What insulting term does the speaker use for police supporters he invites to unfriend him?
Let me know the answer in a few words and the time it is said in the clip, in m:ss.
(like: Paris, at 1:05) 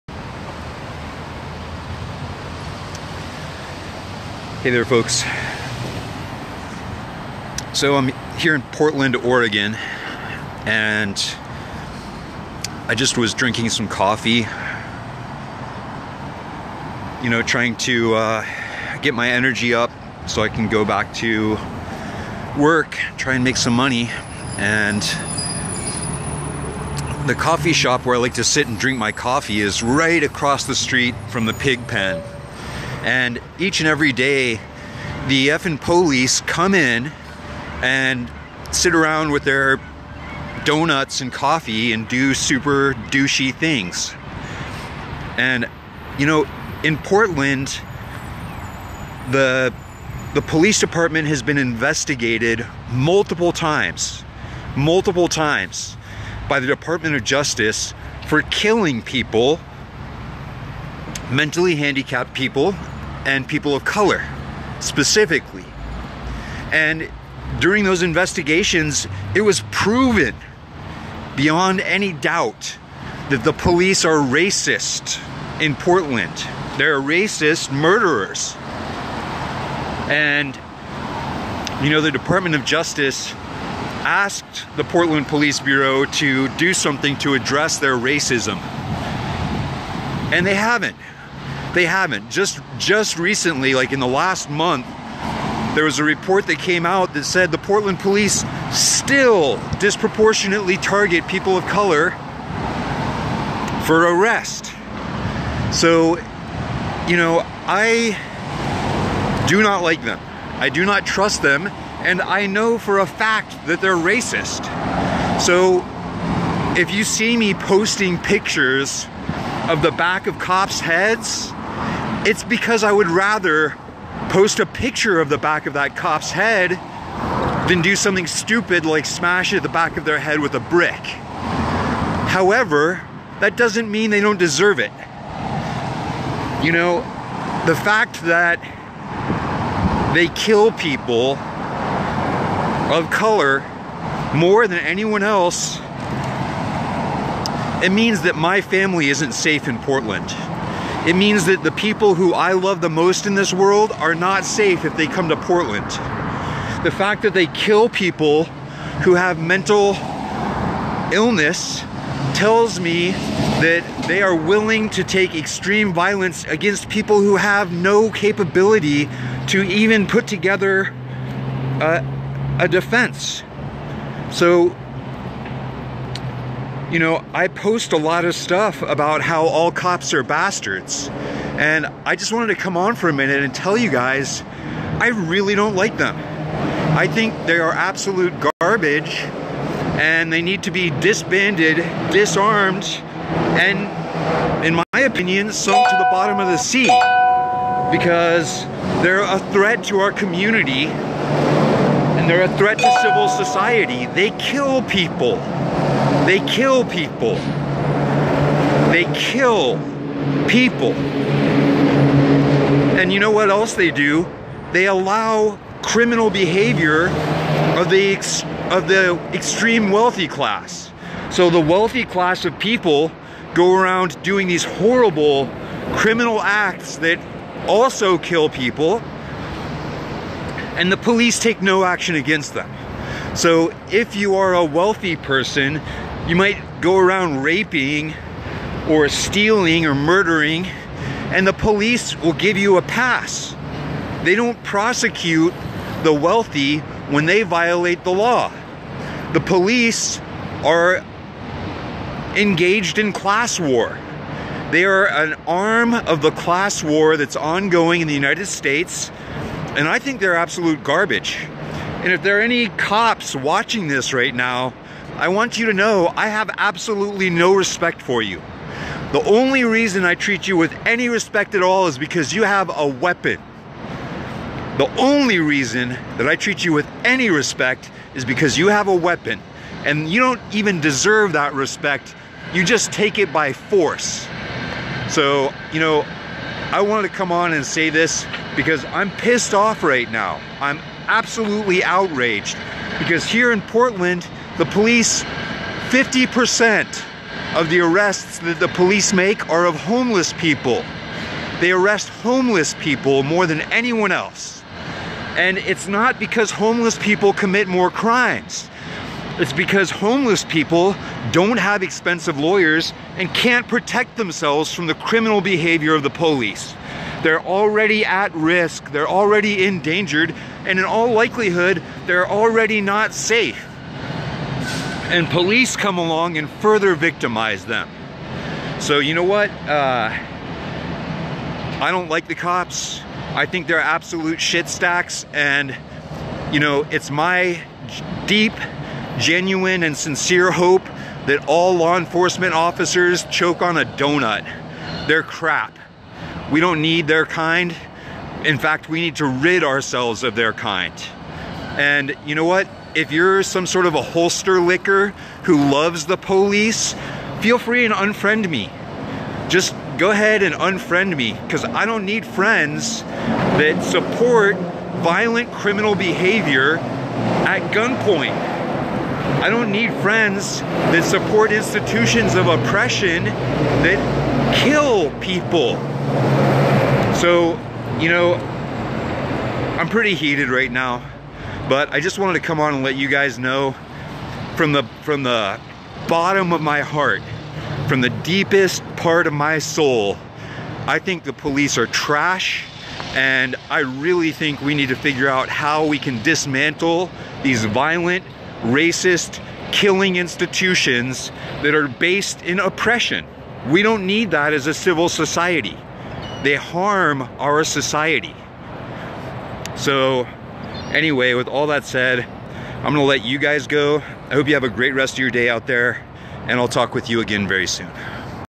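holster licker, at 5:54.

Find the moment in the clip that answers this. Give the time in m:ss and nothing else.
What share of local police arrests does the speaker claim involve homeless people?
4:55.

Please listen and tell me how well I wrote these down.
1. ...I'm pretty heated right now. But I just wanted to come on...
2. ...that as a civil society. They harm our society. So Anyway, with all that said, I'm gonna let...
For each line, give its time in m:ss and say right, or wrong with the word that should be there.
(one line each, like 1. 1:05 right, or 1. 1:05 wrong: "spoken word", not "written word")
1. 6:19 right
2. 6:44 right.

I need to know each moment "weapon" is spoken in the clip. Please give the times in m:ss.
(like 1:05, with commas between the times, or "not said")
4:32, 4:38.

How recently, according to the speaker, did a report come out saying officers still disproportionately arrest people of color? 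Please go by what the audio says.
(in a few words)
in the last month.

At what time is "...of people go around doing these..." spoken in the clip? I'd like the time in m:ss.
3:42.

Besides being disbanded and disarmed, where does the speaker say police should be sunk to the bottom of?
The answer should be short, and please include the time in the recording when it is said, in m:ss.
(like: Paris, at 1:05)
the sea, at 3:16.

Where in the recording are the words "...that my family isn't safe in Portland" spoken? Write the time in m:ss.
2:28.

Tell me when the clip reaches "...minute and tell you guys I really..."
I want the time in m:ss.
3:03.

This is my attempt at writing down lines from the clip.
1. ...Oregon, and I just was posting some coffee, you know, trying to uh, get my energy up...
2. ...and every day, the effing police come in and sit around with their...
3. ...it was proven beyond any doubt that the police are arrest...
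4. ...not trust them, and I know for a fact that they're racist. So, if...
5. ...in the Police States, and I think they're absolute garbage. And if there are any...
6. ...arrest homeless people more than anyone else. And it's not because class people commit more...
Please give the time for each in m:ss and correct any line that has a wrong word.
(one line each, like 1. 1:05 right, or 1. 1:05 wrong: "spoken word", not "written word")
1. 0:09 wrong: "drinking", not "posting"
2. 0:33 right
3. 1:09 wrong: "racist", not "arrest"
4. 1:50 right
5. 4:17 wrong: "United", not "Police"
6. 5:01 wrong: "homeless", not "class".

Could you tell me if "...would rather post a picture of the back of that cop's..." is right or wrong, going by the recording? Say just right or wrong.
right.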